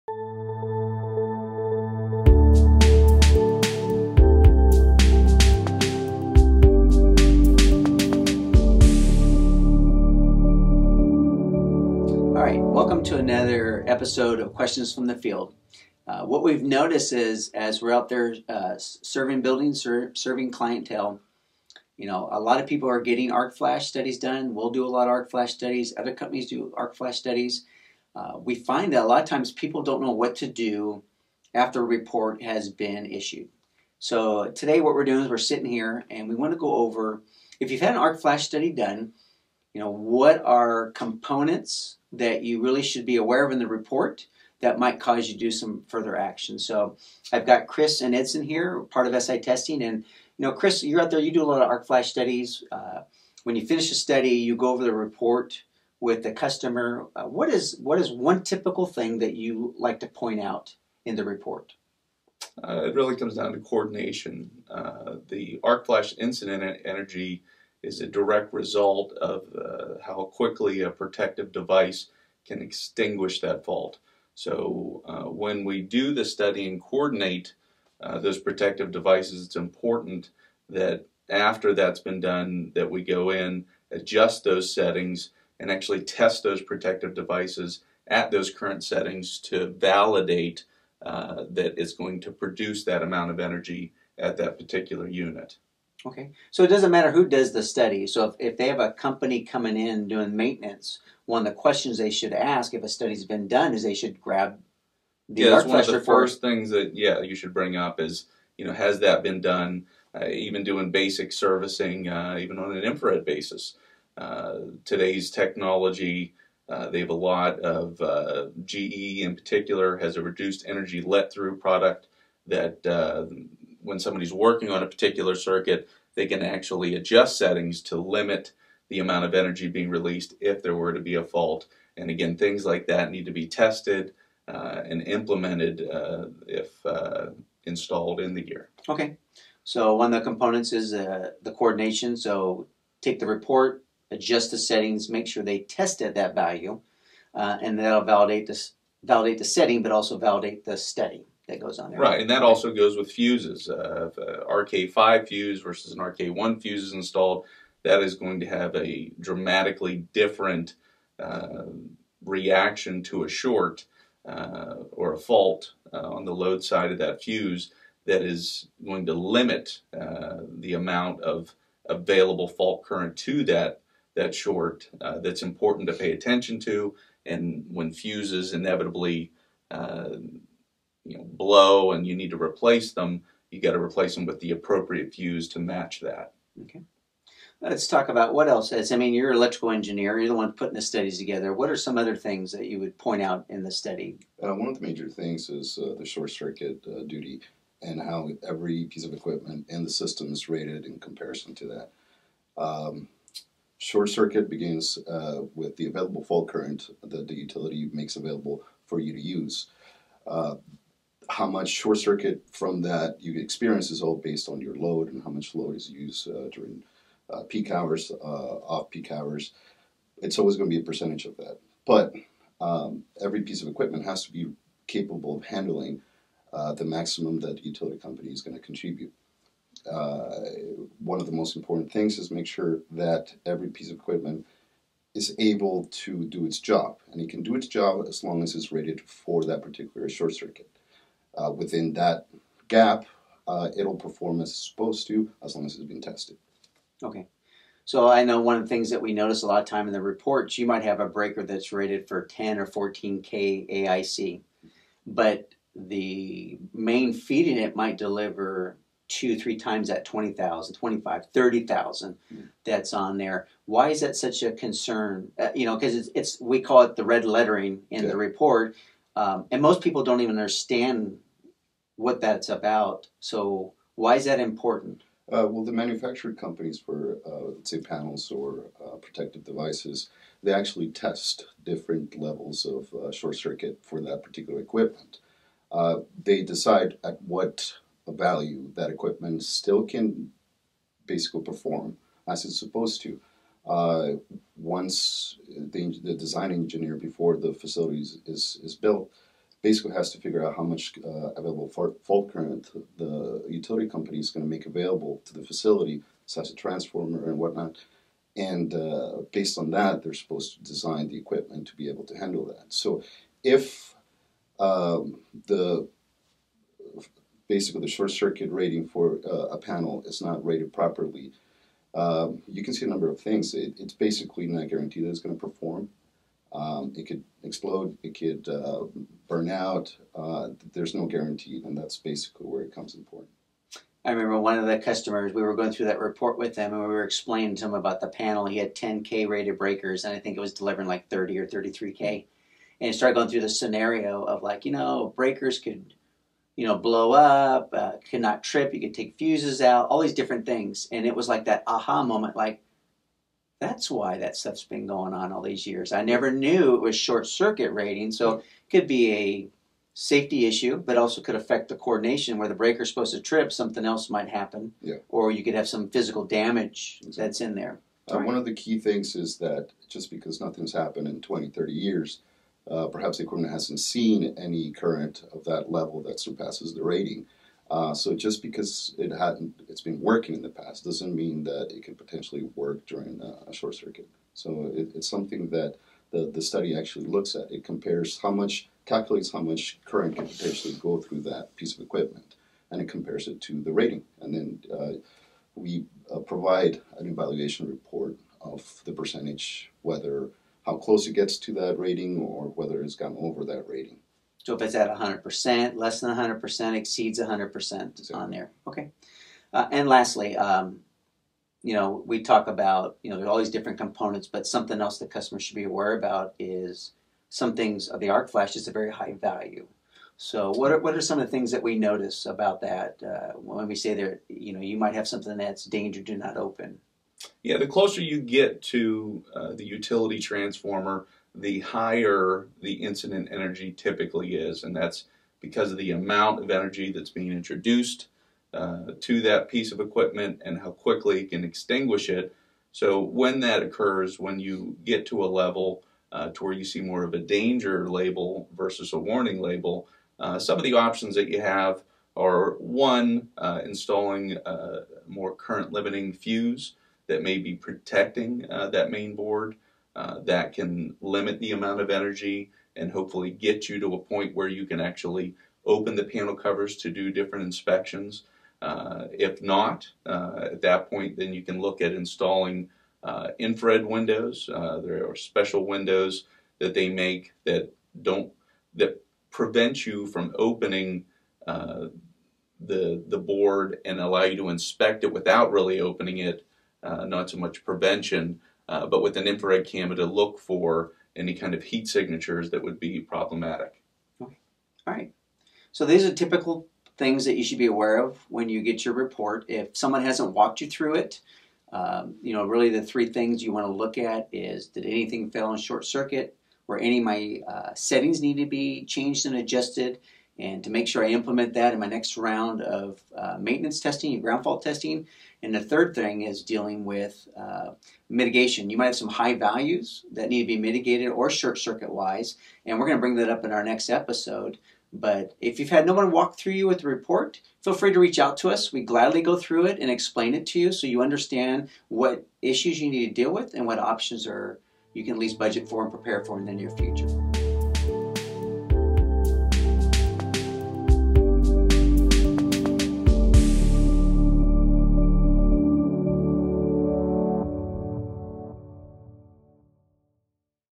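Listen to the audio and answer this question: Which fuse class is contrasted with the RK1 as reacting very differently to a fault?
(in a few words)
RK5.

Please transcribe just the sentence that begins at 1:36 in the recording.
Okay, so it doesn't matter who does the study.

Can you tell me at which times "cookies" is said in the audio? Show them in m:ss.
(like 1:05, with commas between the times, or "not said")
not said.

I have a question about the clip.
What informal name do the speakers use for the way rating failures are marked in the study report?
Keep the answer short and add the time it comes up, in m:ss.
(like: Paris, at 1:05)
red lettering, at 4:27.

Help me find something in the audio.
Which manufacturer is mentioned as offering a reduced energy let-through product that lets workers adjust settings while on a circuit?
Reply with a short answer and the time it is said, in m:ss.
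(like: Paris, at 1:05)
GE, at 1:58.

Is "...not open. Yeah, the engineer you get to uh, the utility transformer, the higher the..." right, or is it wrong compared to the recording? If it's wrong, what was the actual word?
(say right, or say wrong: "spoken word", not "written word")
wrong: "closer", not "engineer".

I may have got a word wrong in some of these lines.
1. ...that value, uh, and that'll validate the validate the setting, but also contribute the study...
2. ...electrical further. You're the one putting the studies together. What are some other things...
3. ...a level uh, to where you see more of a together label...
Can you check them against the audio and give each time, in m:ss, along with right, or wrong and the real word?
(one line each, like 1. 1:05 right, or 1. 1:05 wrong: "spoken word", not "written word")
1. 2:26 wrong: "validate", not "contribute"
2. 3:09 wrong: "engineer", not "further"
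3. 7:25 wrong: "danger", not "together".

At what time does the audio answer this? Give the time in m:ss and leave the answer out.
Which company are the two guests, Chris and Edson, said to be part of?
0:49.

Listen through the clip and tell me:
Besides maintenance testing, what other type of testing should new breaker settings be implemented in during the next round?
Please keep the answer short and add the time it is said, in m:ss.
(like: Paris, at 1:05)
ground fault testing, at 8:34.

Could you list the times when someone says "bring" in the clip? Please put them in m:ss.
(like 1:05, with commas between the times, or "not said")
1:47, 8:43.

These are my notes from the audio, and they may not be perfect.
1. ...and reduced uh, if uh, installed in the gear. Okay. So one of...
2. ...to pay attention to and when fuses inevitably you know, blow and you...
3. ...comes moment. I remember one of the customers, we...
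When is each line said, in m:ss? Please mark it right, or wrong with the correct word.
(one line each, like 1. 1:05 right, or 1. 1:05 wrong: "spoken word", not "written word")
1. 2:14 wrong: "implemented", not "reduced"
2. 2:55 right
3. 5:32 wrong: "important", not "moment".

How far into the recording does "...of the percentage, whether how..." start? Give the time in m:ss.
6:38.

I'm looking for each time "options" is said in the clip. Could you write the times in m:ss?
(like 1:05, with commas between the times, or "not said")
7:30, 8:53.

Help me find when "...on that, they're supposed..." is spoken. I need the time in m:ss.
5:09.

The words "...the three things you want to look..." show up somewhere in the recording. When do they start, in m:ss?
8:22.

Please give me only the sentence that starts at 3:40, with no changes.
It's always going to be a percentage of that.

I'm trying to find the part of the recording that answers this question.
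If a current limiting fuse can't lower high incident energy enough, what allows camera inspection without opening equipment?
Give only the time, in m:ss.
7:53.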